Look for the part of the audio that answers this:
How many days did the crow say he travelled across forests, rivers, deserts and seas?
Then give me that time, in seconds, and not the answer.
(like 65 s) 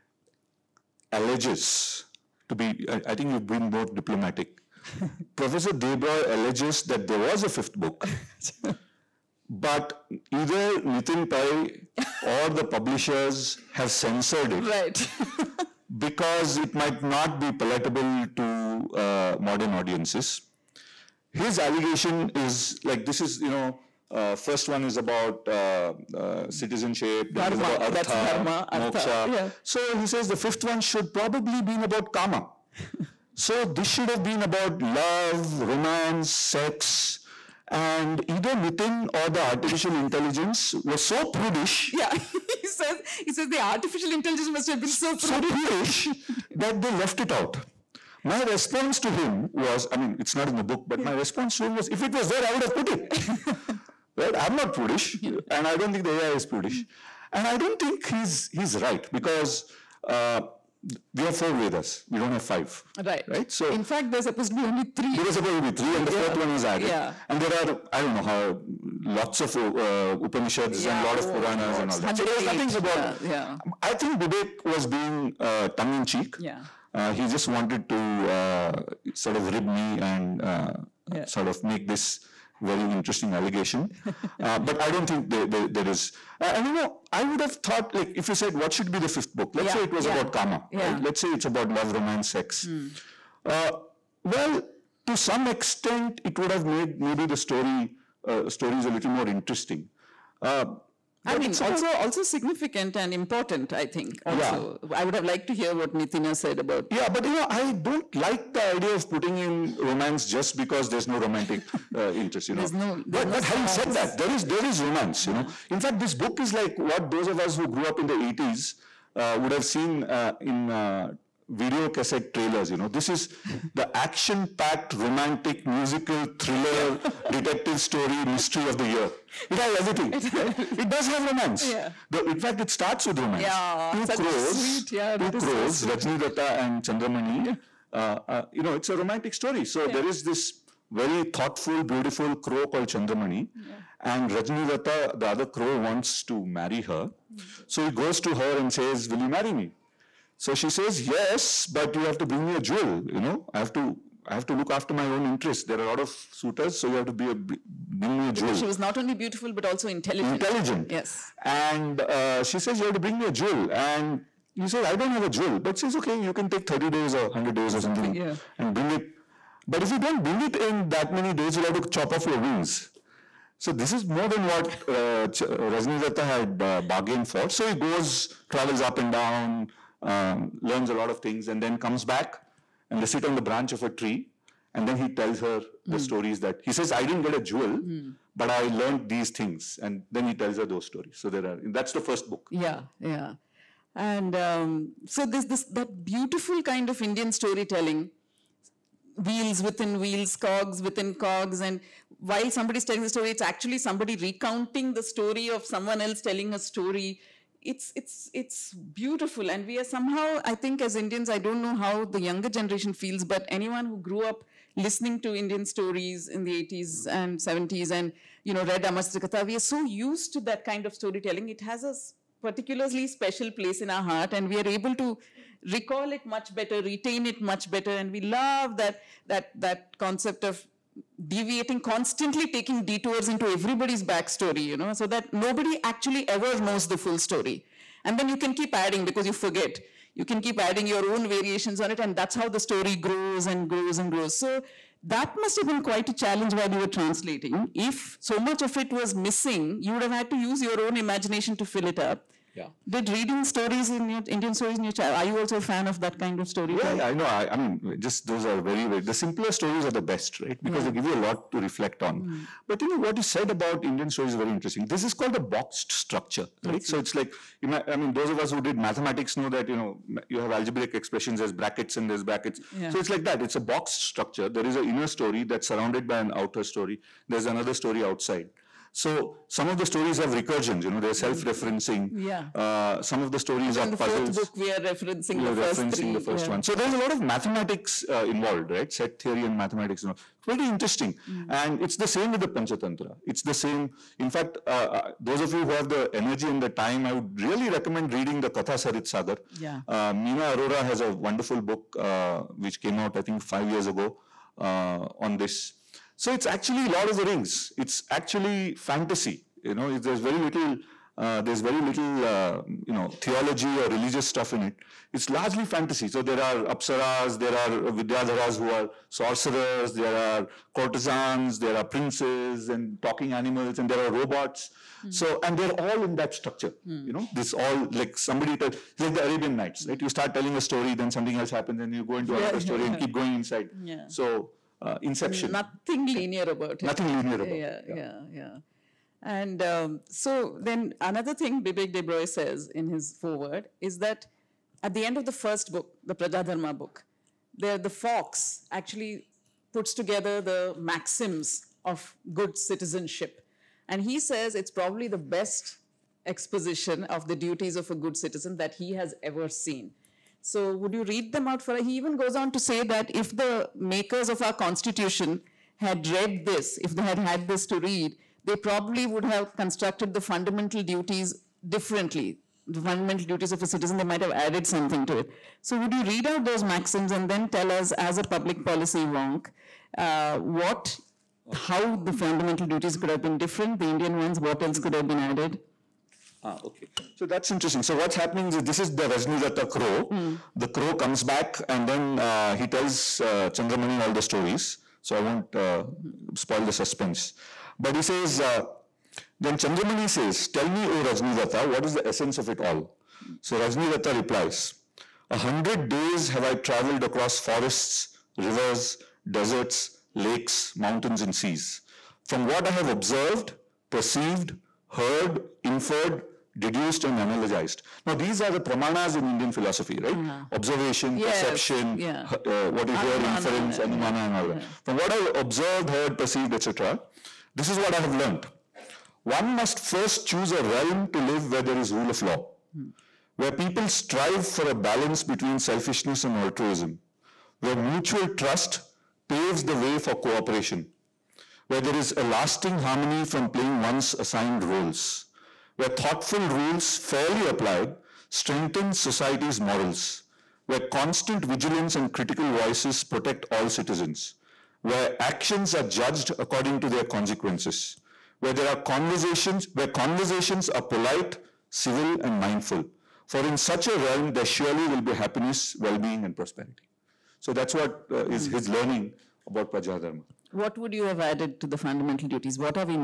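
405 s.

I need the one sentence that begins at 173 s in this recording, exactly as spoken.
So this is more than what uh, Rajni had uh, bargained for.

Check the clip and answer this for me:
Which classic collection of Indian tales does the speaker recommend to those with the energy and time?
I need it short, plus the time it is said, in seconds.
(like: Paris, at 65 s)
Katha Sarit Sagar, at 298 s.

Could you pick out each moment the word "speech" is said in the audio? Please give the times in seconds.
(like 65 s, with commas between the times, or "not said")
not said.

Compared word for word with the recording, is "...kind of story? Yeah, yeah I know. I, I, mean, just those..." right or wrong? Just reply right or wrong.
right.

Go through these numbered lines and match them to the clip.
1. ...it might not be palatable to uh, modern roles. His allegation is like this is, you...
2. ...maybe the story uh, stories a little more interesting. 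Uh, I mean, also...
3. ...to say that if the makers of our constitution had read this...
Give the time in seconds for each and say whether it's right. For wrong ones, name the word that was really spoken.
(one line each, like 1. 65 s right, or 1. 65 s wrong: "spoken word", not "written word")
1. 16 s wrong: "audiences", not "roles"
2. 97 s right
3. 362 s right.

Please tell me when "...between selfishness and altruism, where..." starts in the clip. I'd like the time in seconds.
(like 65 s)
435 s.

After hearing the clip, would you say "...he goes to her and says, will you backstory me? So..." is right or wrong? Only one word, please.
wrong.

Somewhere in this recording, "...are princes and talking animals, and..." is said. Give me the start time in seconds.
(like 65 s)
321 s.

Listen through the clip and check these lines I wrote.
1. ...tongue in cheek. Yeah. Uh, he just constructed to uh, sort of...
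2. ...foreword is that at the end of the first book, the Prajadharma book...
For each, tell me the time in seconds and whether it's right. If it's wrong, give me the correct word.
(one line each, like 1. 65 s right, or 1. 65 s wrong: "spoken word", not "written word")
1. 75 s wrong: "wanted", not "constructed"
2. 343 s right.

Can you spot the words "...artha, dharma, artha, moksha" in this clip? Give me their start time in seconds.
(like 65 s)
27 s.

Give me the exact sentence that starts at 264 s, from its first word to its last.
This is called the boxed structure, right?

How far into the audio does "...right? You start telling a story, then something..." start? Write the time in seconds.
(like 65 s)
329 s.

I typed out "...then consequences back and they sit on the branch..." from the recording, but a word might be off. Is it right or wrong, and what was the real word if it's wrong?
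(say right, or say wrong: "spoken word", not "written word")
wrong: "comes", not "consequences".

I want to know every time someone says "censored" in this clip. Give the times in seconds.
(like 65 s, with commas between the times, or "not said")
13 s.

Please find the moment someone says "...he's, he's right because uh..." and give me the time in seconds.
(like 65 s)
58 s.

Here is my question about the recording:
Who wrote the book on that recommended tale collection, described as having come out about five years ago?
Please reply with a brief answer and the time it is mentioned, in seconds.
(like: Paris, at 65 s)
Meena Arora, at 300 s.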